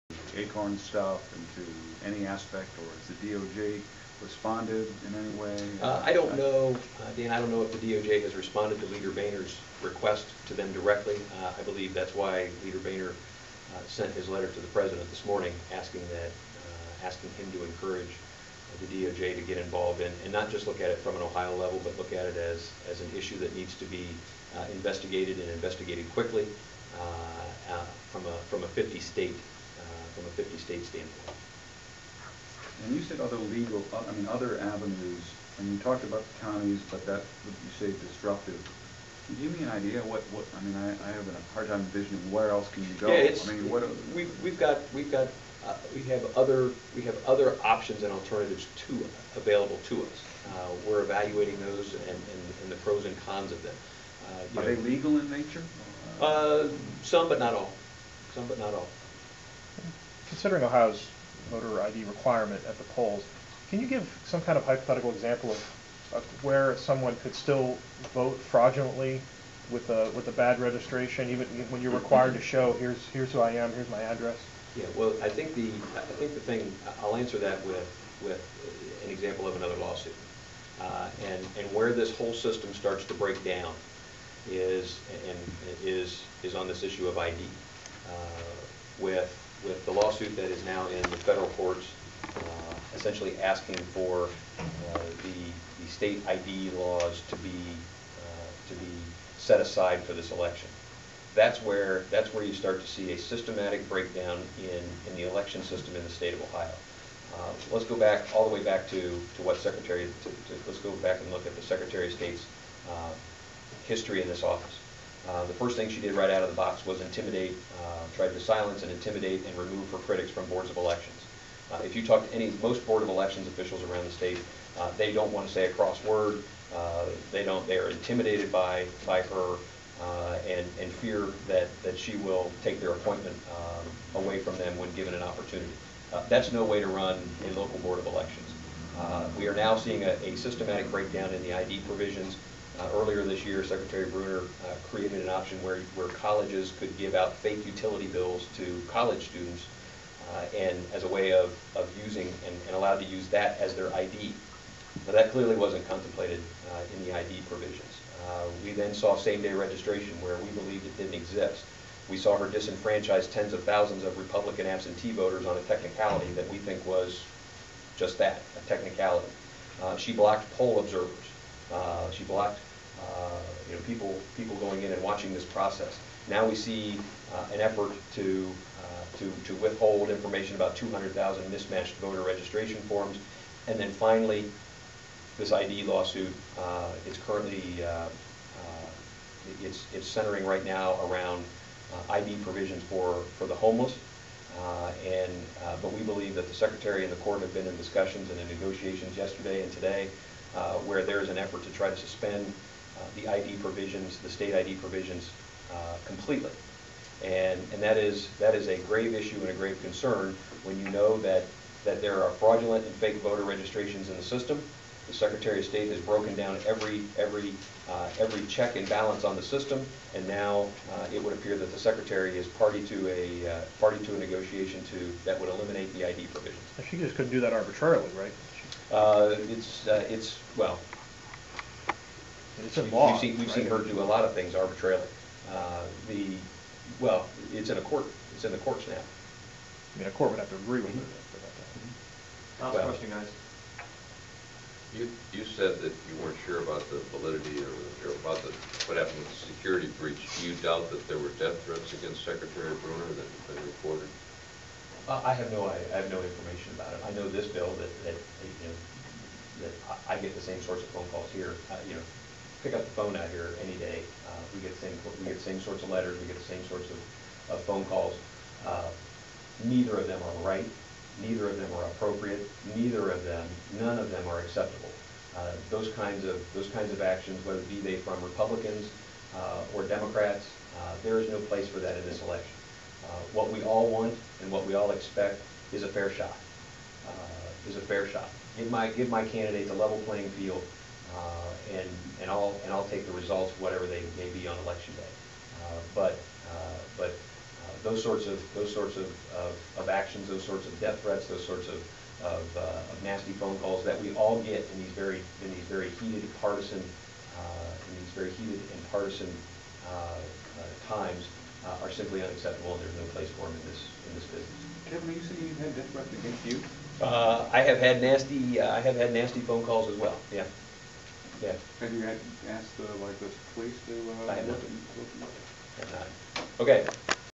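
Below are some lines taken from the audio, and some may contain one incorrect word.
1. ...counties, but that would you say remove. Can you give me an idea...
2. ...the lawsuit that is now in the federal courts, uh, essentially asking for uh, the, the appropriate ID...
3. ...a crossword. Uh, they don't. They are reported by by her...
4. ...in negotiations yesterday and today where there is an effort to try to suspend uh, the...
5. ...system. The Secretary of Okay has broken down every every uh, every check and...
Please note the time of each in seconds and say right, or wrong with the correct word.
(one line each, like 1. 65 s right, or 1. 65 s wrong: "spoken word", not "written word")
1. 36 s wrong: "disruptive", not "remove"
2. 89 s wrong: "state", not "appropriate"
3. 125 s wrong: "intimidated", not "reported"
4. 198 s right
5. 214 s wrong: "State", not "Okay".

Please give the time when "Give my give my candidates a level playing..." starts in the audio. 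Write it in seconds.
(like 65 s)
288 s.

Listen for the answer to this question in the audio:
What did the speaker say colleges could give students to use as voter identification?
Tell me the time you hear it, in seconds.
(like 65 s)
147 s.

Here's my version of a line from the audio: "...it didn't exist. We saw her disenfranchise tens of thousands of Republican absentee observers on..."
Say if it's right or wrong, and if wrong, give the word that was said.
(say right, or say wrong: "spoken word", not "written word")
wrong: "voters", not "observers".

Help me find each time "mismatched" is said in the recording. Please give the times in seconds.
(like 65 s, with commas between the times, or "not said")
181 s.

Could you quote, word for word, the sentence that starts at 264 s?
Uh, we get the same we get the same sorts of letters.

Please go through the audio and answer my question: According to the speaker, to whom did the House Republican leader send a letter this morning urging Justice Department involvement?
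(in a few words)
The president.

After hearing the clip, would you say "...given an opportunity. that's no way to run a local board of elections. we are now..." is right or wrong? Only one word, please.
right.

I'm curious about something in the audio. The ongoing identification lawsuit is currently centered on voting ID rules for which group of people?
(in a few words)
The homeless.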